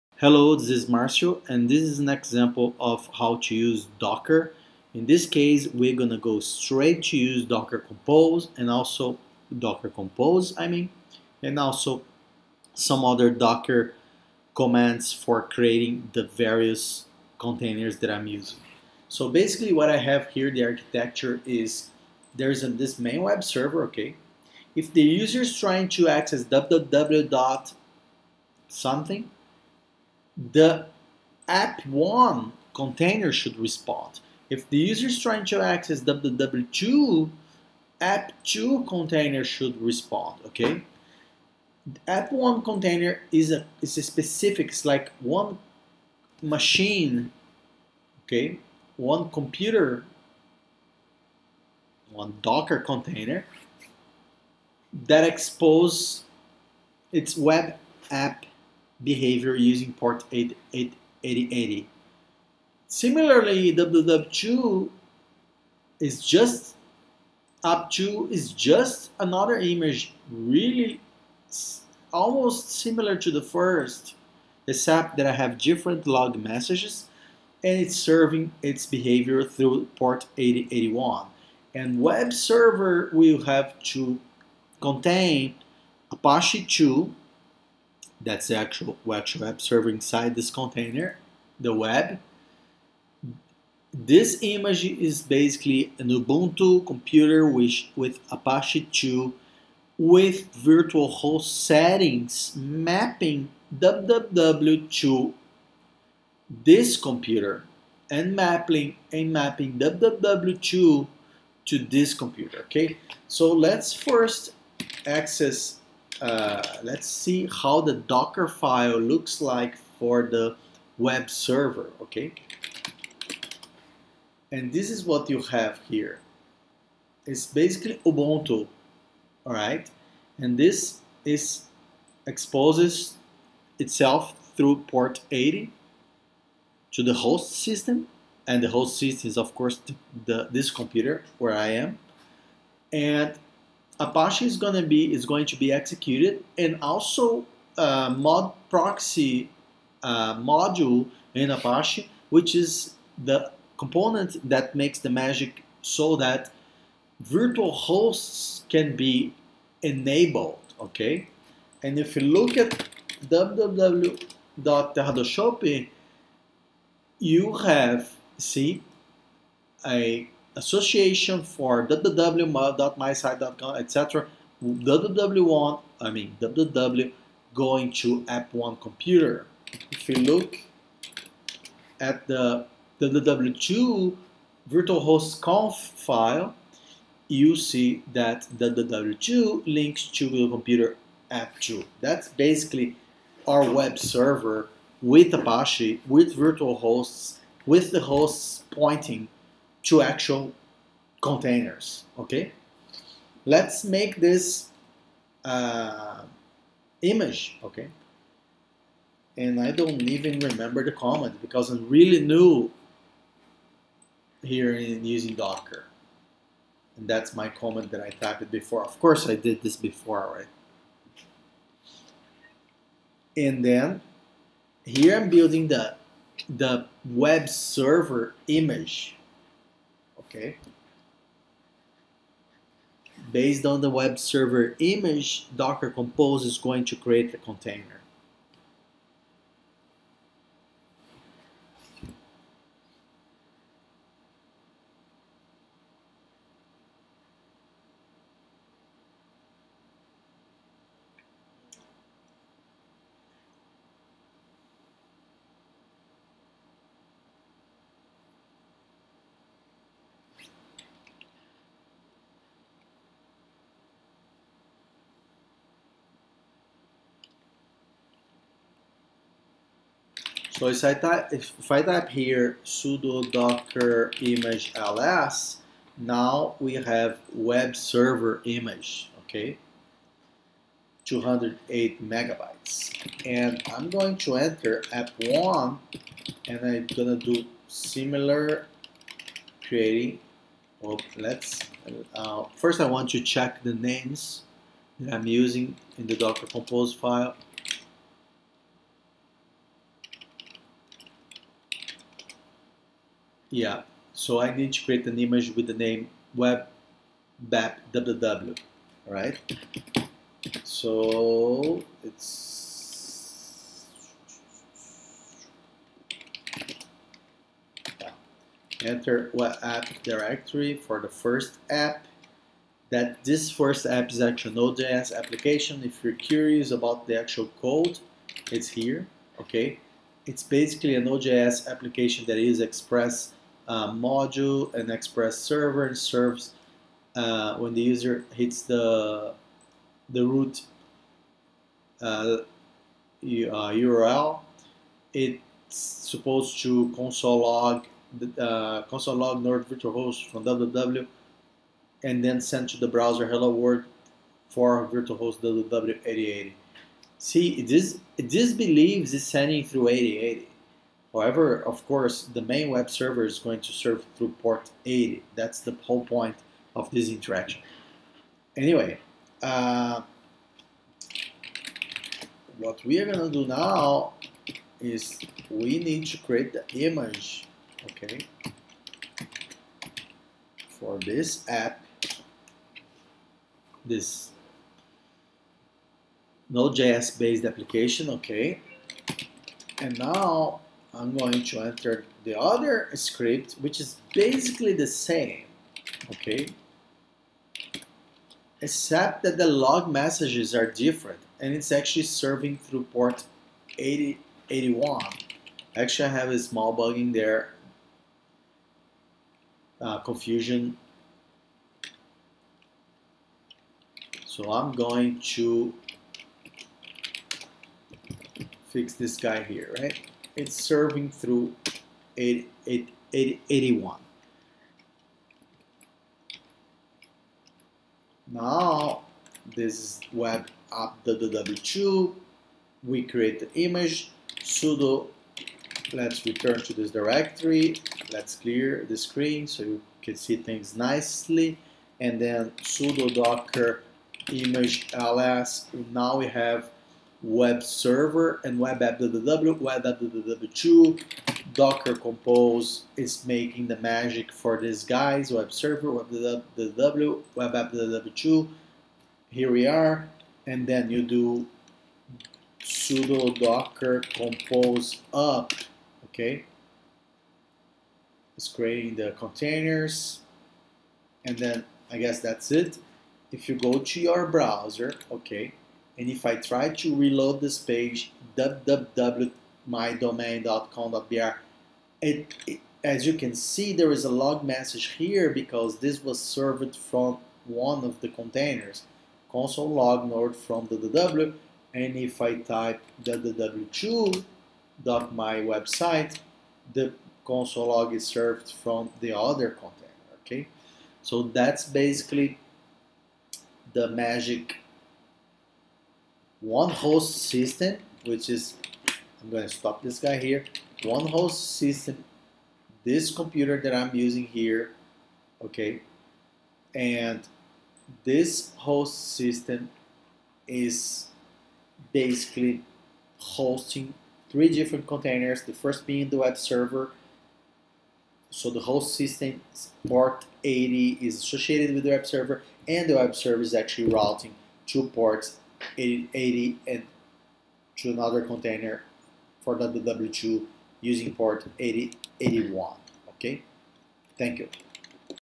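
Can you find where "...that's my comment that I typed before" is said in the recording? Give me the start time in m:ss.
3:37.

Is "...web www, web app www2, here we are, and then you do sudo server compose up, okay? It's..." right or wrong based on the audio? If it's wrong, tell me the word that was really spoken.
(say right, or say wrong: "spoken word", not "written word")
wrong: "docker", not "server".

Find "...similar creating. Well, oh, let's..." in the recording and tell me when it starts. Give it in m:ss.
4:47.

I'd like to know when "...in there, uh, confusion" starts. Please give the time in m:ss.
6:46.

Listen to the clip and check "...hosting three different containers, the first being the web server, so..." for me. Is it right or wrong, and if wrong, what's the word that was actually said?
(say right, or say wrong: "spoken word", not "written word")
right.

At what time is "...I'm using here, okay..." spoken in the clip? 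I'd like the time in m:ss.
8:33.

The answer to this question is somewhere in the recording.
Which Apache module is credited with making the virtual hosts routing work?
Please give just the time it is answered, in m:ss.
2:28.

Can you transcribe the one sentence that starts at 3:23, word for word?
Let's make this uh, image, okay?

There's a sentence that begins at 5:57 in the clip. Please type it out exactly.
See, this this believes it's sending through 8080.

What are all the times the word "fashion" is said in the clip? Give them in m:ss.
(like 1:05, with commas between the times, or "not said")
not said.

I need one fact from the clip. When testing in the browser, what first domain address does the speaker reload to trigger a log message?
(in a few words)
www.mydomain.com.br.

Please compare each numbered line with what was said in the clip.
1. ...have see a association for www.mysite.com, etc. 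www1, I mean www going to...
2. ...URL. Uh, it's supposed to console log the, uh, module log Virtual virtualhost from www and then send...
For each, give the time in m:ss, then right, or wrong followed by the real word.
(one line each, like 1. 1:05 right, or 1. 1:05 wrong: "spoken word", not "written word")
1. 2:47 right
2. 5:43 wrong: "console", not "module".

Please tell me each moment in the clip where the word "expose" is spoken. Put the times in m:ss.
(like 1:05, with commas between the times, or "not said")
0:55, 2:12.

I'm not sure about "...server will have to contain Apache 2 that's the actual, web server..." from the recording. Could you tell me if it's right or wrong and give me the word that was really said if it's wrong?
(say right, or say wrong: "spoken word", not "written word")
right.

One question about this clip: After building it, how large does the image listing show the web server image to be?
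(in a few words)
208 megabytes.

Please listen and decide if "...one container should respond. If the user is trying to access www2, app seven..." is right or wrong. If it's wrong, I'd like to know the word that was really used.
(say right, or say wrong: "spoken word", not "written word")
wrong: "two", not "seven".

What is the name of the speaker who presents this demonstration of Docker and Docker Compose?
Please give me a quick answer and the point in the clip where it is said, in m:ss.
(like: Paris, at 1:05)
Marcio, at 0:00.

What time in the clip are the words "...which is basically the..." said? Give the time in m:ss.
6:33.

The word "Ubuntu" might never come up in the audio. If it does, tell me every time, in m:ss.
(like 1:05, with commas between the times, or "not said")
1:36, 2:08.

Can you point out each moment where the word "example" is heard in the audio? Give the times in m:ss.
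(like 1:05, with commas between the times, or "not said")
0:02.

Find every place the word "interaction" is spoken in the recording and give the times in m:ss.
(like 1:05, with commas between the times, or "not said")
6:07.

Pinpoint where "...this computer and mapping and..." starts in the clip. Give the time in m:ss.
1:46.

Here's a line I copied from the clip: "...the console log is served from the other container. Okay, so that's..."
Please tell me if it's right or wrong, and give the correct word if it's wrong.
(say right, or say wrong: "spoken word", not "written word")
right.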